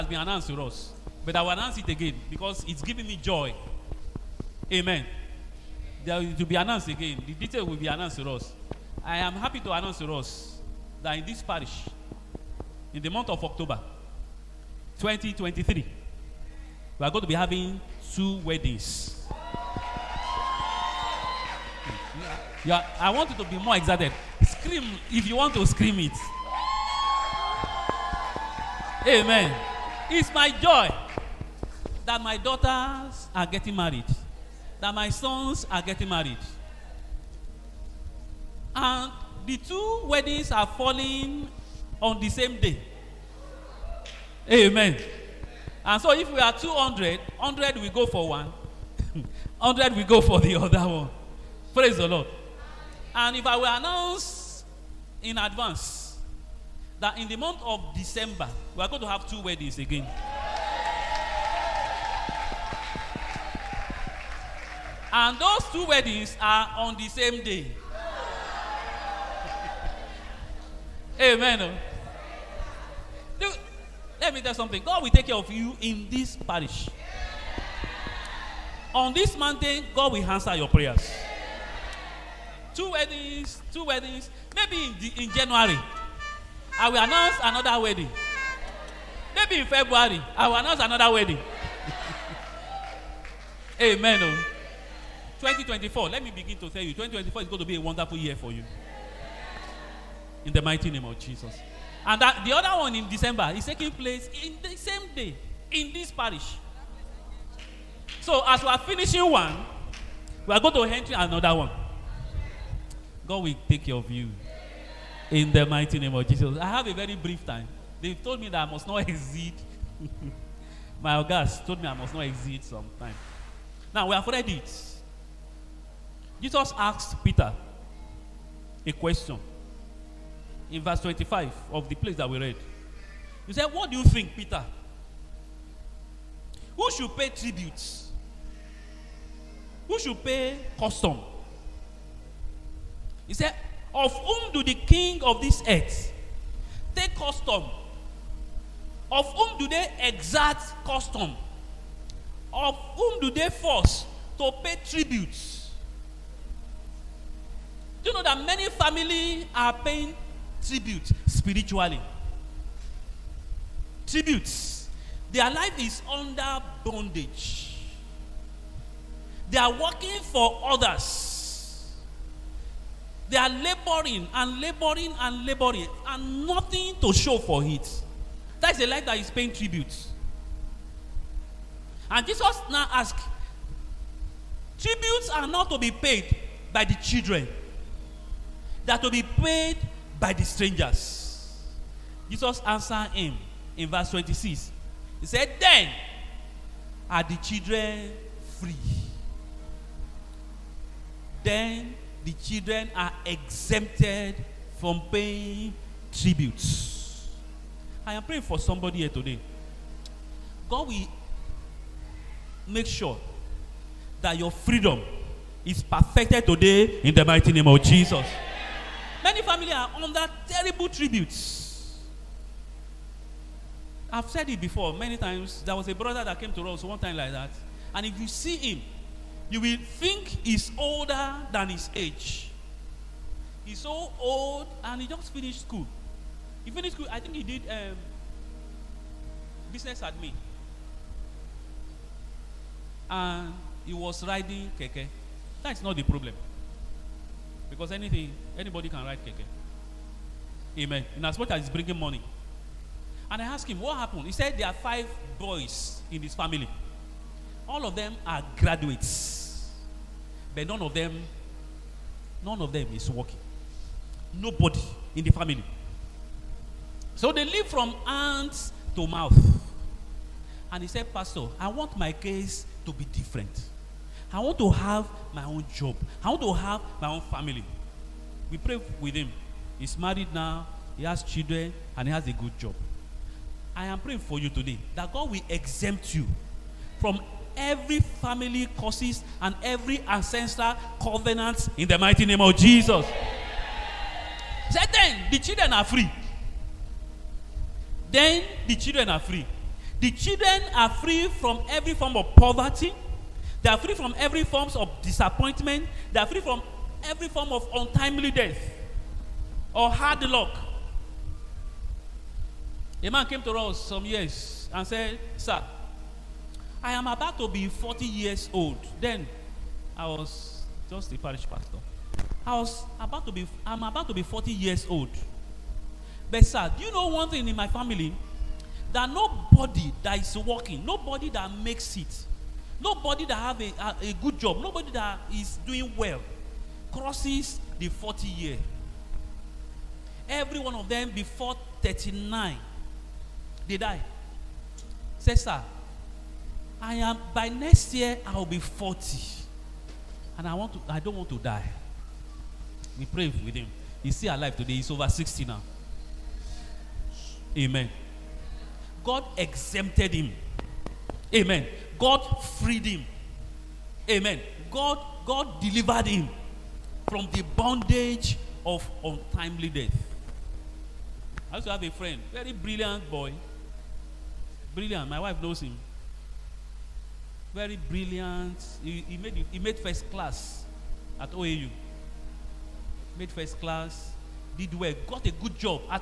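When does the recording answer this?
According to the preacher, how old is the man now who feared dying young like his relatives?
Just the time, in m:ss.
5:54.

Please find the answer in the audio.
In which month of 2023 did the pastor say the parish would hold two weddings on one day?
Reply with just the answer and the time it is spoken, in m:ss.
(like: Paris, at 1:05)
October, at 0:13.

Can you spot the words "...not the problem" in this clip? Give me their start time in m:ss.
4:05.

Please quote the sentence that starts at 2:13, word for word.
He said, What do you think, Peter?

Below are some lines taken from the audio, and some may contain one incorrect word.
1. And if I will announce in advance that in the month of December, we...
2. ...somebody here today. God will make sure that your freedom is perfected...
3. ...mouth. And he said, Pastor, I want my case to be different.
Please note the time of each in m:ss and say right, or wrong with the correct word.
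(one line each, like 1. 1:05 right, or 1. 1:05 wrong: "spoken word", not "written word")
1. 0:53 right
2. 3:28 right
3. 4:29 right.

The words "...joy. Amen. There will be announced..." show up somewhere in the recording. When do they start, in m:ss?
0:03.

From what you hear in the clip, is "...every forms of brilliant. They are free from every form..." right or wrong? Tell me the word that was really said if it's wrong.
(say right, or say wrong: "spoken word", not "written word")
wrong: "disappointment", not "brilliant".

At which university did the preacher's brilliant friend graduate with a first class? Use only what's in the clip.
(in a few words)
OAU.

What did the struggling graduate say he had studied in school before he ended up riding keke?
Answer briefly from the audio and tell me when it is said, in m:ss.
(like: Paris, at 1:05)
Business admin, at 3:59.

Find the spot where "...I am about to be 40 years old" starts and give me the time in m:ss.
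5:16.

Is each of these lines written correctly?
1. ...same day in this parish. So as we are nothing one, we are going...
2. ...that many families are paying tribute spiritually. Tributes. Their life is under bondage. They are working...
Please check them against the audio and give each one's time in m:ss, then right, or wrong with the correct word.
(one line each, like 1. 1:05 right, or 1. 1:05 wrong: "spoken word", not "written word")
1. 1:44 wrong: "finishing", not "nothing"
2. 2:38 right.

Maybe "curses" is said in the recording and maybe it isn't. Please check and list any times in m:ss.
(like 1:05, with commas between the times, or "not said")
4:48.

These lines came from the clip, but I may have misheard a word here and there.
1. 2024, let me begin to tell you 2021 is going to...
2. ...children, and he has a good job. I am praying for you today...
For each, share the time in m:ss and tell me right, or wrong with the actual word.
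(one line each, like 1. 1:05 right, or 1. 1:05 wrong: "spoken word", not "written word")
1. 1:35 wrong: "2024", not "2021"
2. 4:41 right.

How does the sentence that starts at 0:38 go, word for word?
And the two weddings are falling on the same day.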